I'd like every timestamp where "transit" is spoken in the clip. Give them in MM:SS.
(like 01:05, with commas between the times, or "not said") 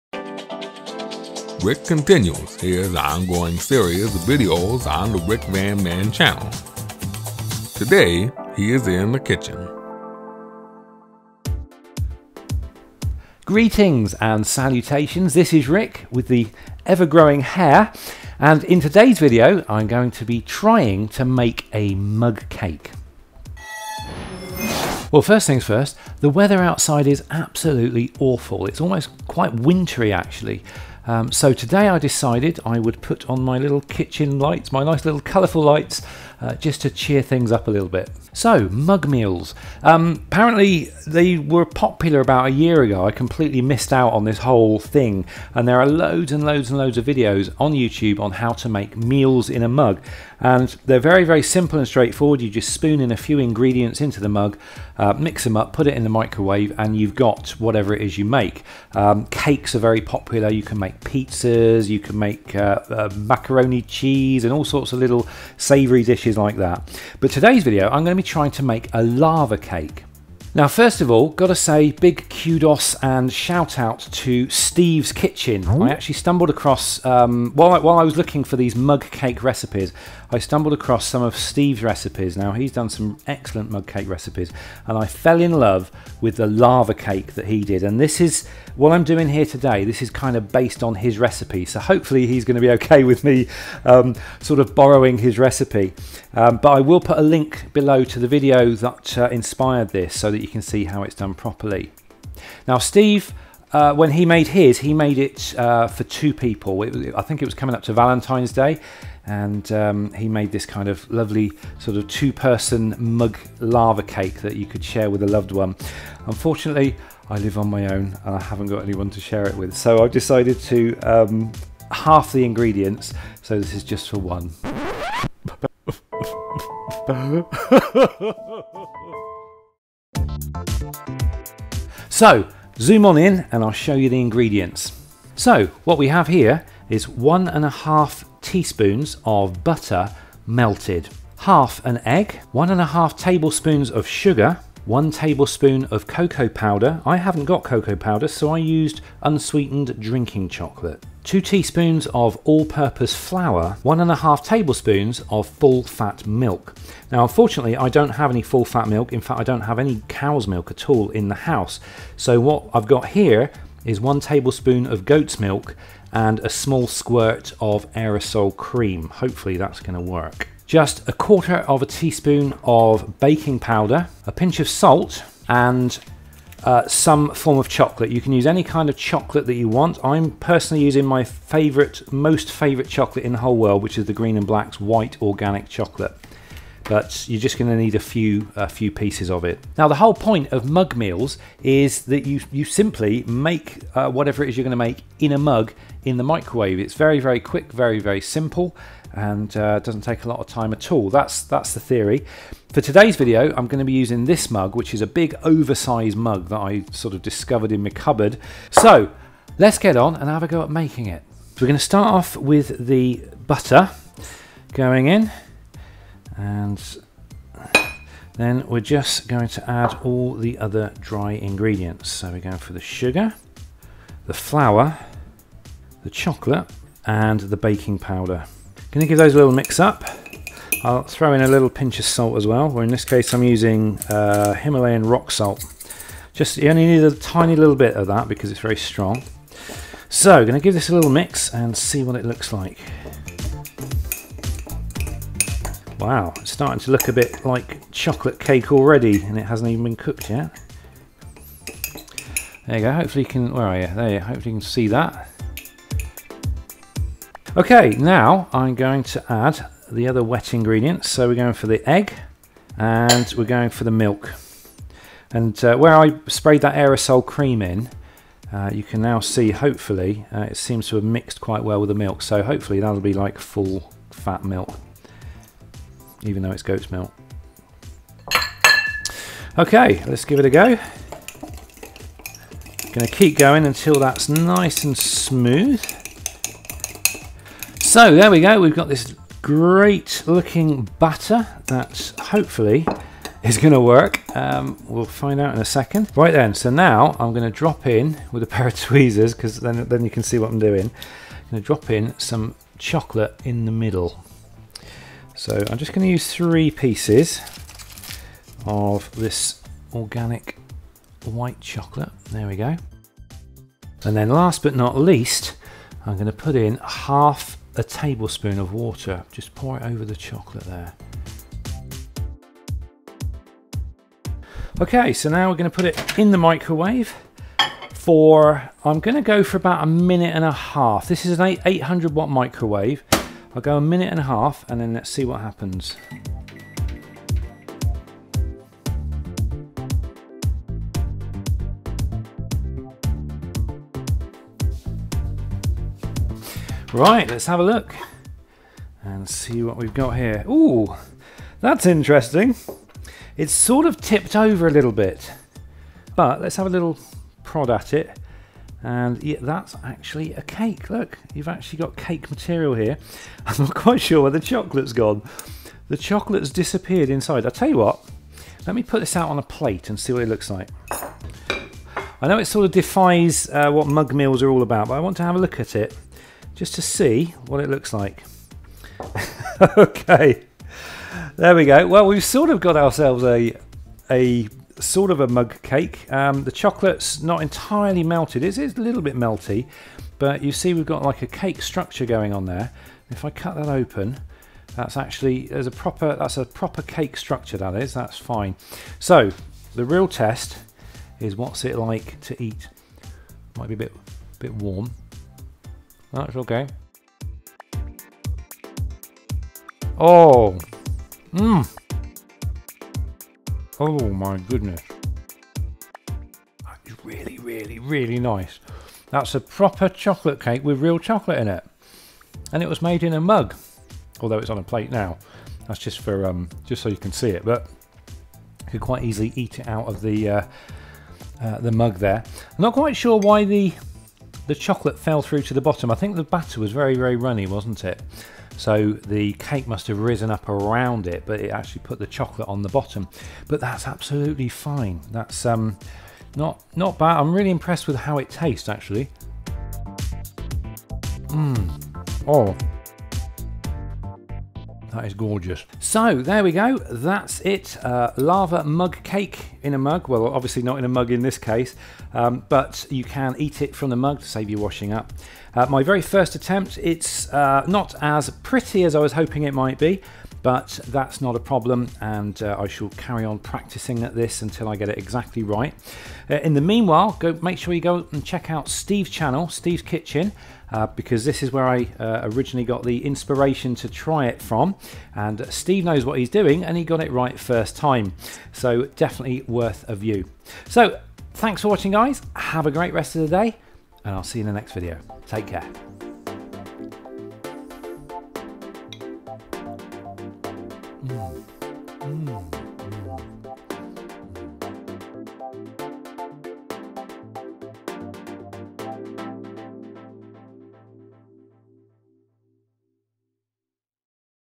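not said.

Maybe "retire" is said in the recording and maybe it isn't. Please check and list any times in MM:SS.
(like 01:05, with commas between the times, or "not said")
not said.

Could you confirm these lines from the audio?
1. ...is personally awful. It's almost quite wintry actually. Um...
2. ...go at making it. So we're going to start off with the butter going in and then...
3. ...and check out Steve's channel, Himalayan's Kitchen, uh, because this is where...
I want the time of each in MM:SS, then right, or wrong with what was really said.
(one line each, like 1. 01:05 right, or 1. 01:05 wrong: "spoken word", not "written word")
1. 00:27 wrong: "absolutely", not "personally"
2. 03:30 right
3. 07:58 wrong: "Steve", not "Himalayan".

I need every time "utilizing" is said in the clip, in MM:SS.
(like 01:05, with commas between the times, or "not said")
not said.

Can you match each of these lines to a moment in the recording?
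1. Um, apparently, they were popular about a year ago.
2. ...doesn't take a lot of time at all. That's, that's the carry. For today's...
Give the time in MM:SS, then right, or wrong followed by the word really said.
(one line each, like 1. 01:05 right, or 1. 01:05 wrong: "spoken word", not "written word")
1. 00:39 right
2. 03:19 wrong: "theory", not "carry".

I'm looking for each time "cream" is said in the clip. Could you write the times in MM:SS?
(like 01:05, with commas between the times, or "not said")
02:48, 04:27.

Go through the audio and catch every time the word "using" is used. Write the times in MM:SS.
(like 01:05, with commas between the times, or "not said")
03:00, 03:23, 03:53.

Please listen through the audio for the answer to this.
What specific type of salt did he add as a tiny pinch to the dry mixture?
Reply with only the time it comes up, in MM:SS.
03:54.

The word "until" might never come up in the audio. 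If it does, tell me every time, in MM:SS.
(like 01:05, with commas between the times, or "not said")
04:43, 07:54.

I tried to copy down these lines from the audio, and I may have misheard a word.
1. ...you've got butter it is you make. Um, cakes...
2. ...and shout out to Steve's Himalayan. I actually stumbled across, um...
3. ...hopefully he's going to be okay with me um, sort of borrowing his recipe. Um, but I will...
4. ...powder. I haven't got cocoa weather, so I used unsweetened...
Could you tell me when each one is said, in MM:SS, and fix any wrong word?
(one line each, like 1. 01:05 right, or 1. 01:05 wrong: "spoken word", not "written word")
1. 00:56 wrong: "whatever", not "butter"
2. 01:13 wrong: "Kitchen", not "Himalayan"
3. 01:31 right
4. 02:26 wrong: "powder", not "weather".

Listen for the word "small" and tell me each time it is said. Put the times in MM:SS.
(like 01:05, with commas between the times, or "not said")
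02:46.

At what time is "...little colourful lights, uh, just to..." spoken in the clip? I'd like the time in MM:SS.
00:35.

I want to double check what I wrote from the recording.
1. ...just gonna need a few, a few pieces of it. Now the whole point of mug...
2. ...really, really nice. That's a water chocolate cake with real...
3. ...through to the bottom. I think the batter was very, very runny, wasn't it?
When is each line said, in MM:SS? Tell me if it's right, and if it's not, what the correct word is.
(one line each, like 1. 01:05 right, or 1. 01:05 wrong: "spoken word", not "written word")
1. 03:07 right
2. 06:57 wrong: "proper", not "water"
3. 07:15 right.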